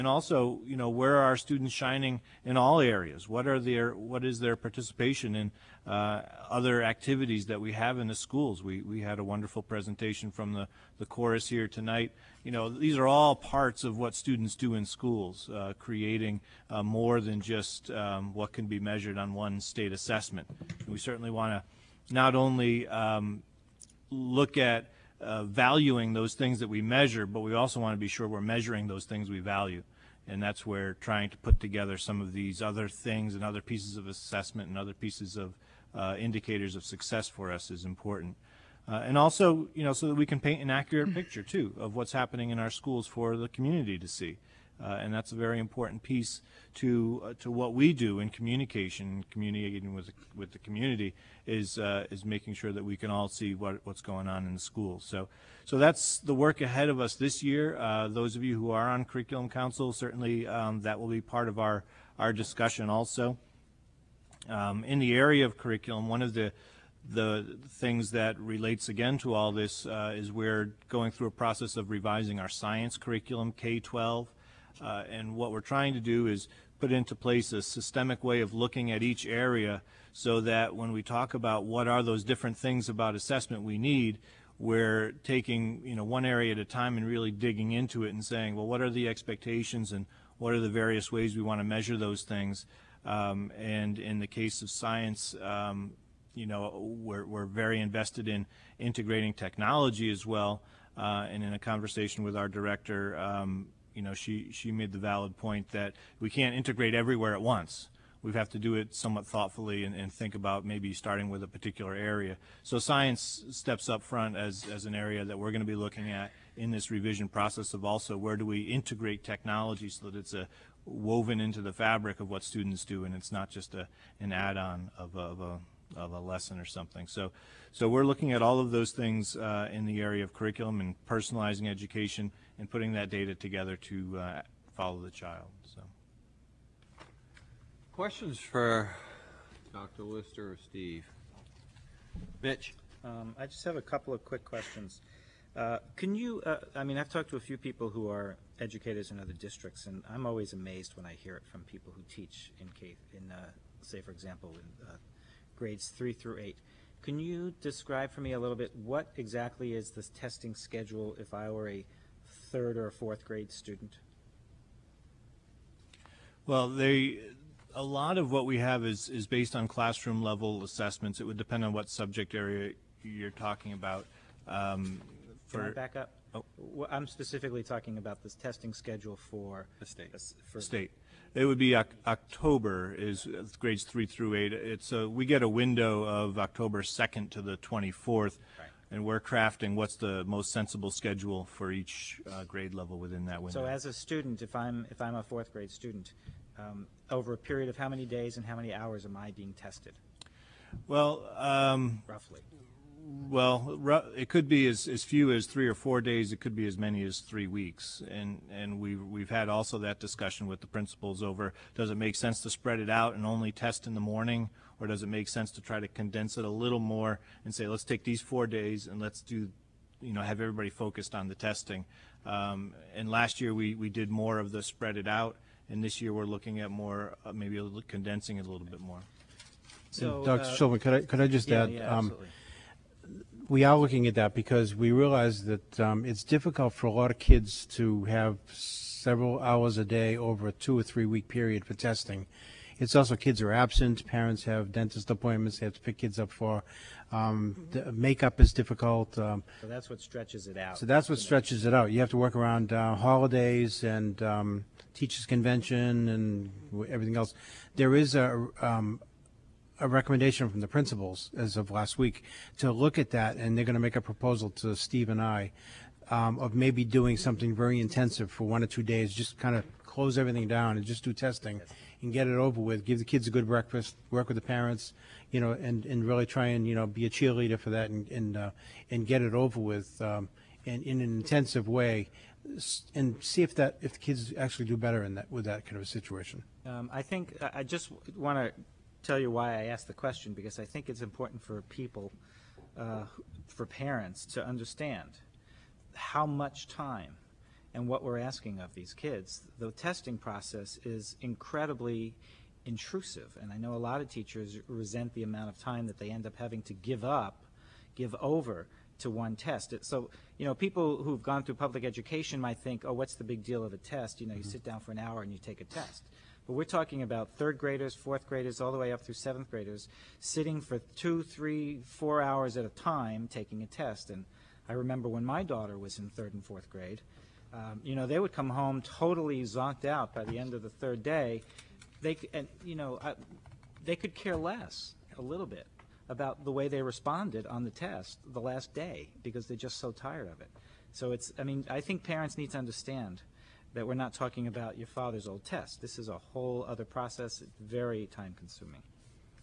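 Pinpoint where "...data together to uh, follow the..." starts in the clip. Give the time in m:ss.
2:13.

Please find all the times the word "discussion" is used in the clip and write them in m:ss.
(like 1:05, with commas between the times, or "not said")
1:02, 3:29.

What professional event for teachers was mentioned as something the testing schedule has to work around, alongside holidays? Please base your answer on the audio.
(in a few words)
Teachers' convention.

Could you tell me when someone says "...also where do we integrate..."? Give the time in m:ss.
1:57.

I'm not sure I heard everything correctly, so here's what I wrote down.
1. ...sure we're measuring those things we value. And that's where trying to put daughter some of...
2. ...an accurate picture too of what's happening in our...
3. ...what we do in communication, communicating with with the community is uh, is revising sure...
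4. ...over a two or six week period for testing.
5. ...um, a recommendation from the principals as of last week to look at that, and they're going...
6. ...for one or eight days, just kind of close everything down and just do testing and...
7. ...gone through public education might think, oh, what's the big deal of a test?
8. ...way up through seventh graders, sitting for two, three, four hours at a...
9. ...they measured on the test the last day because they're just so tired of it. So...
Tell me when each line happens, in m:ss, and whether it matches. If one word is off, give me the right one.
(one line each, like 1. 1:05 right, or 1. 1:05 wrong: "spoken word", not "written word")
1. 0:28 wrong: "together", not "daughter"
2. 0:40 right
3. 0:47 wrong: "making", not "revising"
4. 4:00 wrong: "three", not "six"
5. 4:18 right
6. 4:28 wrong: "two", not "eight"
7. 5:11 right
8. 5:18 right
9. 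5:36 wrong: "responded", not "measured".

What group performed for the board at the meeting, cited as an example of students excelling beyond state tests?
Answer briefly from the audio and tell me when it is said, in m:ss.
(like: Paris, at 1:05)
The chorus, at 0:10.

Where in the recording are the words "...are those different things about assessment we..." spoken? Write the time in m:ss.
1:21.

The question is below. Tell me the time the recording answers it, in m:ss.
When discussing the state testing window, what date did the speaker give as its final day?
3:07.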